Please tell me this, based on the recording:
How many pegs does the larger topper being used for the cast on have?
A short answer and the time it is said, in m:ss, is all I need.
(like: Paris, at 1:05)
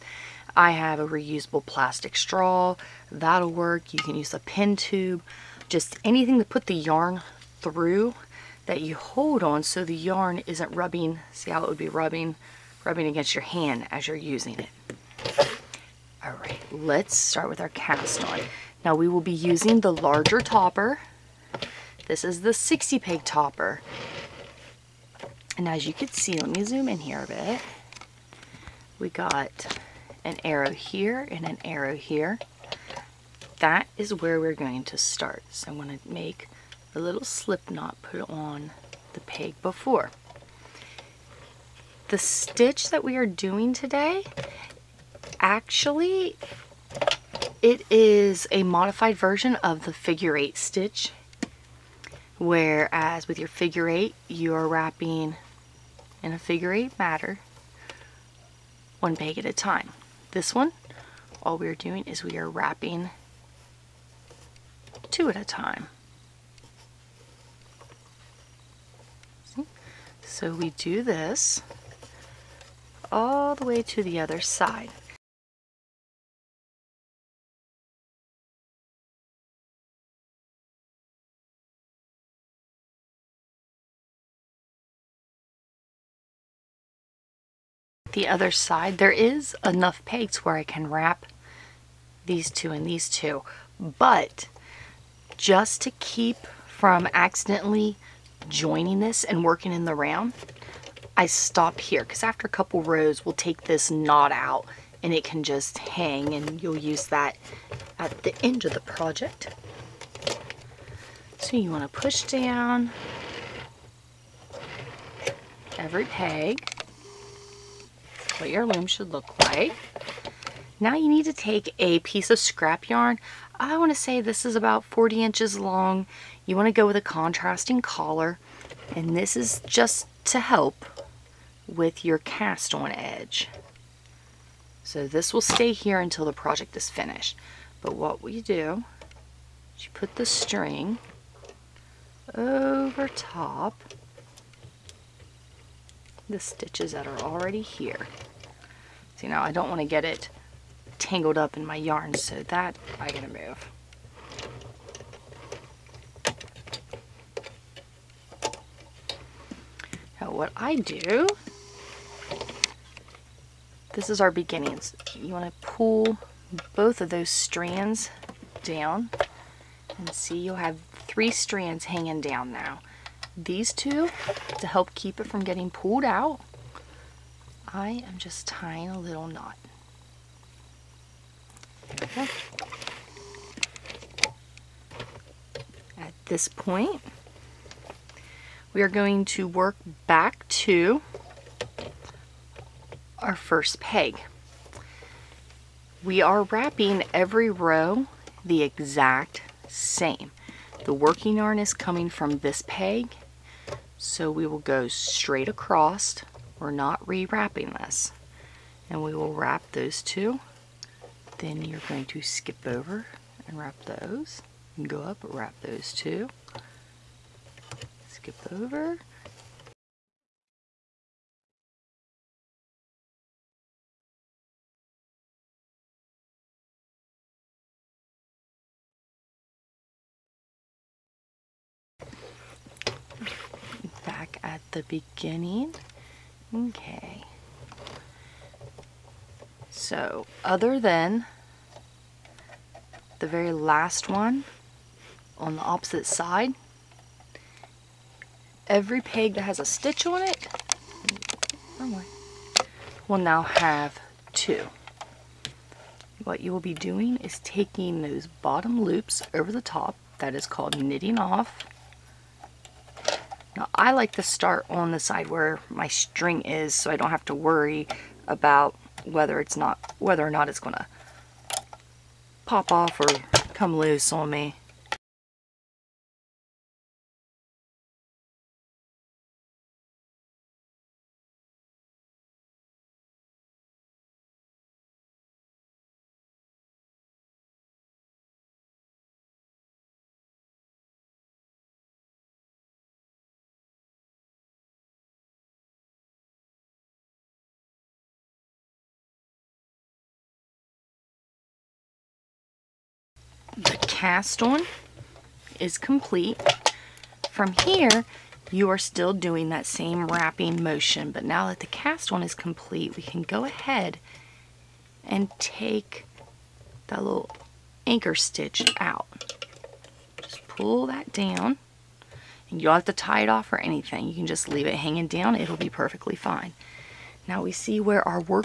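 60, at 0:22.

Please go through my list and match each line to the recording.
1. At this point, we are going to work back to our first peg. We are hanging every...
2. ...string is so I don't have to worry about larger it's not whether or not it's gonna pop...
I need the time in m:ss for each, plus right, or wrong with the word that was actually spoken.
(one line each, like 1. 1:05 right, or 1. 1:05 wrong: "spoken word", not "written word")
1. 3:05 wrong: "wrapping", not "hanging"
2. 4:25 wrong: "whether", not "larger".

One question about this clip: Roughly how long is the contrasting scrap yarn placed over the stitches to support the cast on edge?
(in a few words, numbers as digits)
40 inches.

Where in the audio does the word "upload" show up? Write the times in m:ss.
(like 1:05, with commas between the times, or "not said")
not said.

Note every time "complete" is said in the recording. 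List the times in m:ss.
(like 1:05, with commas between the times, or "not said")
5:05, 5:12.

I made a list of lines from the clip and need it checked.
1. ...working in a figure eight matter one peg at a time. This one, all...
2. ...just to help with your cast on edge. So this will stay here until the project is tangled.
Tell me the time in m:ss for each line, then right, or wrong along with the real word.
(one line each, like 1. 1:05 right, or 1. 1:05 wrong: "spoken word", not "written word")
1. 0:54 wrong: "wrapping", not "working"
2. 2:09 wrong: "finished", not "tangled".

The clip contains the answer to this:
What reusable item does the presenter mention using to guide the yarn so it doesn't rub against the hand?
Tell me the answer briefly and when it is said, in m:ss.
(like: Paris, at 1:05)
plastic straw, at 0:01.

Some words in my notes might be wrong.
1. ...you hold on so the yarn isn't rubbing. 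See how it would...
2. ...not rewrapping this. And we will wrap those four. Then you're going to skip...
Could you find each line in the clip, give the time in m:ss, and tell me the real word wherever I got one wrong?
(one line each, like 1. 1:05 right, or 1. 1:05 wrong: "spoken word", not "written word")
1. 0:08 right
2. 3:26 wrong: "two", not "four".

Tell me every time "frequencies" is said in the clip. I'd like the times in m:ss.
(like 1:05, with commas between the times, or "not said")
not said.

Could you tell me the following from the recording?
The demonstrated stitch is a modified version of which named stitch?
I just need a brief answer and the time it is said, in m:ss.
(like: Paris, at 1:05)
figure eight stitch, at 0:49.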